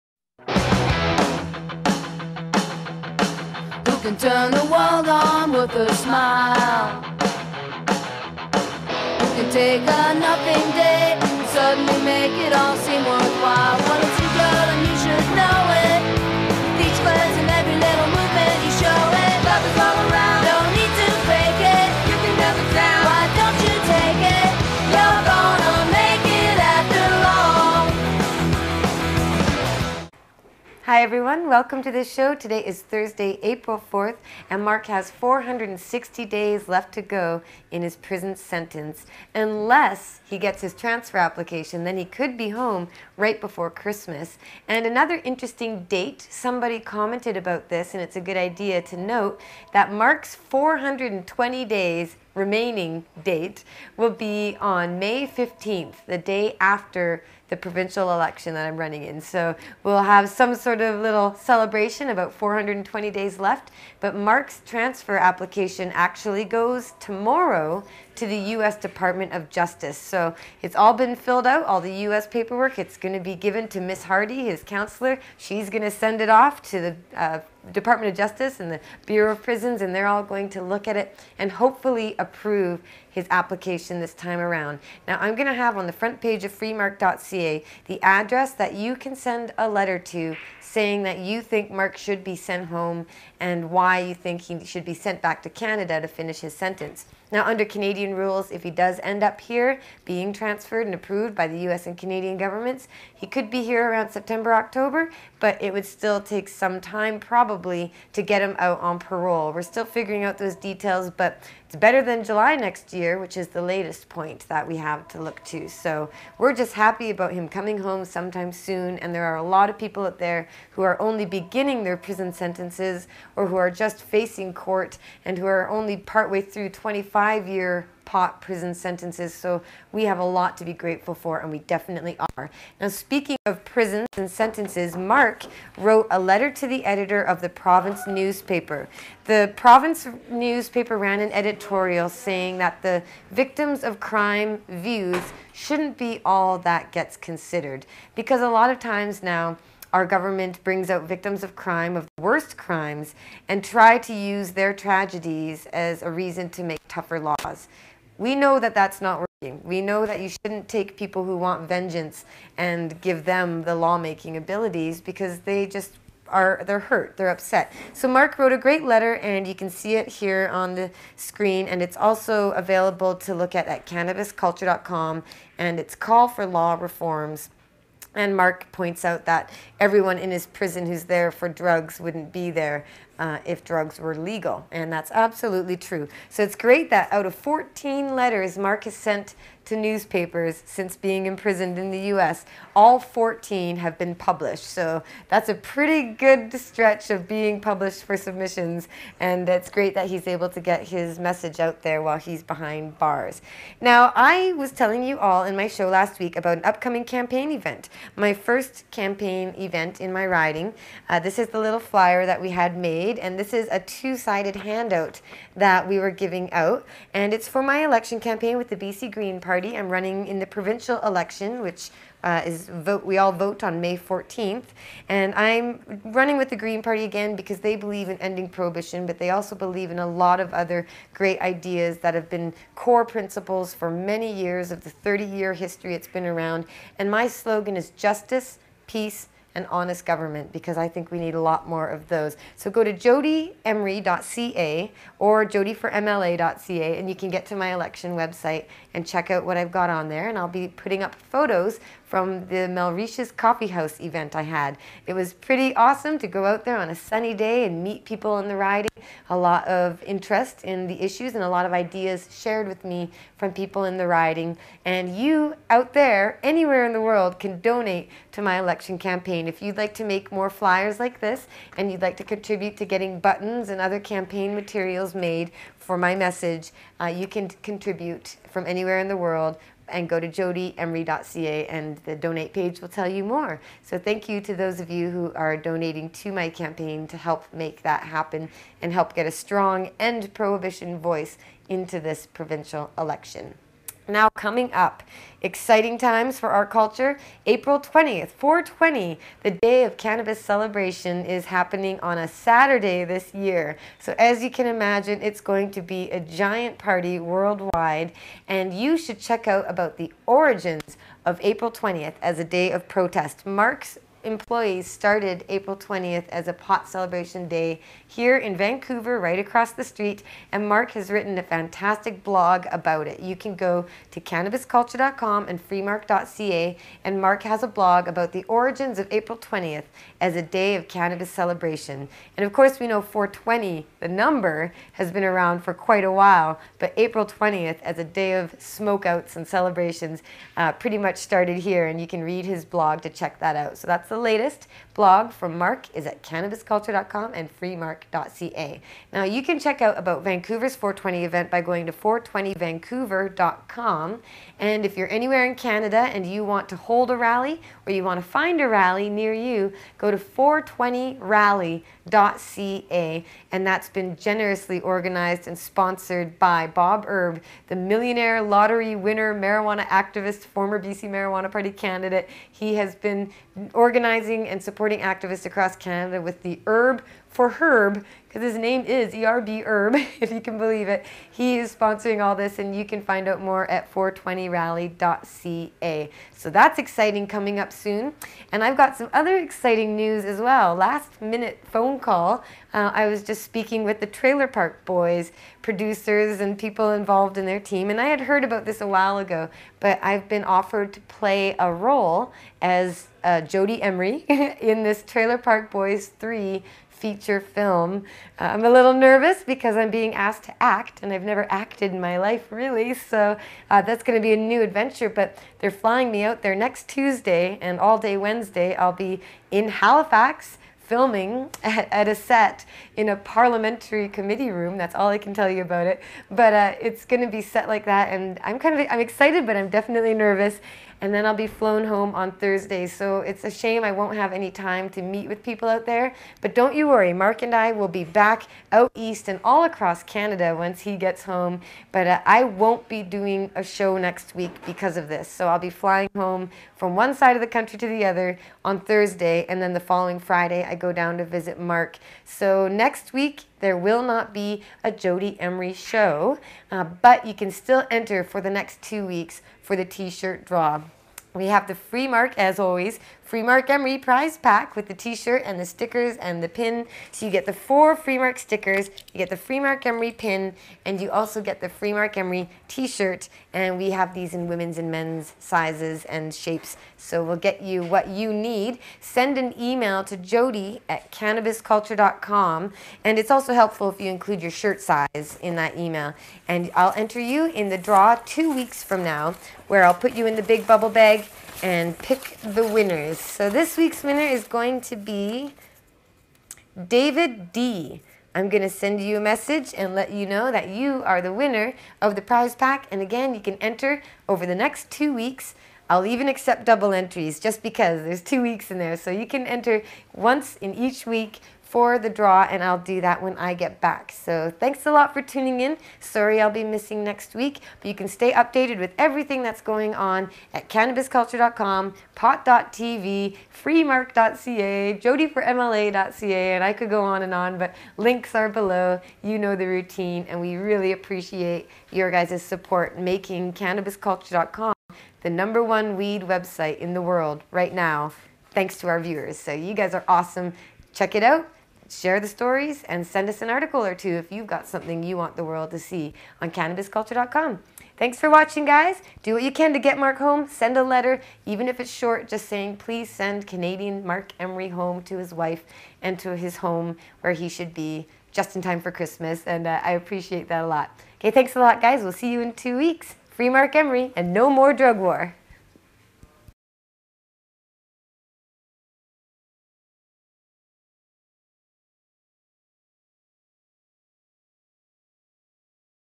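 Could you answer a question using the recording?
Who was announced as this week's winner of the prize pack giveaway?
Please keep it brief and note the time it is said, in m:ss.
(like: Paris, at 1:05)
David D., at 8:16.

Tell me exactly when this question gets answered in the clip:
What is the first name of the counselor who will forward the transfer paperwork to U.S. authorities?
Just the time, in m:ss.
1:13.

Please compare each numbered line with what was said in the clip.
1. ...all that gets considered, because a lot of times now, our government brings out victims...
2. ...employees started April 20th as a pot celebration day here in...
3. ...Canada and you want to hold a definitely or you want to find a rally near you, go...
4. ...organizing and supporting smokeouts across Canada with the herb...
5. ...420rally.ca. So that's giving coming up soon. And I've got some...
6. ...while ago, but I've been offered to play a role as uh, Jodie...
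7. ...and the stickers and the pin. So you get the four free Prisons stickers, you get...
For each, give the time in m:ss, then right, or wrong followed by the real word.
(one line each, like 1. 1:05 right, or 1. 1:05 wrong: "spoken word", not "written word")
1. 2:26 right
2. 5:14 right
3. 5:55 wrong: "rally", not "definitely"
4. 6:14 wrong: "activists", not "smokeouts"
5. 6:23 wrong: "exciting", not "giving"
6. 6:38 right
7. 7:45 wrong: "Marc", not "Prisons".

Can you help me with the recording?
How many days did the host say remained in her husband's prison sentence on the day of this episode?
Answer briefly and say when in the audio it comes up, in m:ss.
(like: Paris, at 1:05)
460, at 0:35.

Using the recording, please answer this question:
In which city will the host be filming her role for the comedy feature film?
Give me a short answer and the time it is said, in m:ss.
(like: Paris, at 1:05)
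Halifax, at 6:59.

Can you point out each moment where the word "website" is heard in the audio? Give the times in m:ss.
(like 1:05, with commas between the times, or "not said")
4:08, 8:56.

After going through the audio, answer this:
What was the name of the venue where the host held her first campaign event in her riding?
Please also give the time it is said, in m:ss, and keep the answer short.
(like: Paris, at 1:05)
Melrisha's Coffee House, at 4:12.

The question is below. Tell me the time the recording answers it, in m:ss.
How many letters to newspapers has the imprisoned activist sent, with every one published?
3:07.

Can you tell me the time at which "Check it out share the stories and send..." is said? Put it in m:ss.
9:00.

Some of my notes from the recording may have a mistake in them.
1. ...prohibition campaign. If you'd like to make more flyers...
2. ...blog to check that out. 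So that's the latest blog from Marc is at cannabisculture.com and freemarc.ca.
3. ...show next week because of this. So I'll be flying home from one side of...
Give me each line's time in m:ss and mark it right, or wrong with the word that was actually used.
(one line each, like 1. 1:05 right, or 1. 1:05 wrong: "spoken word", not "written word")
1. 4:28 wrong: "election", not "prohibition"
2. 5:42 right
3. 7:23 right.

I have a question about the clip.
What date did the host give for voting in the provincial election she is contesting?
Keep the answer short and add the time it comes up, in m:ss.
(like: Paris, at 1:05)
May 14th, at 3:43.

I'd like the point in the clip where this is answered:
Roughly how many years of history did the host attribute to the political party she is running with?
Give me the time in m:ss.
3:55.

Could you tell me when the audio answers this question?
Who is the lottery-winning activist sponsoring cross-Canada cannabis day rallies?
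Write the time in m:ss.
6:06.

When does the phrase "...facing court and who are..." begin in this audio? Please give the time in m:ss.
2:04.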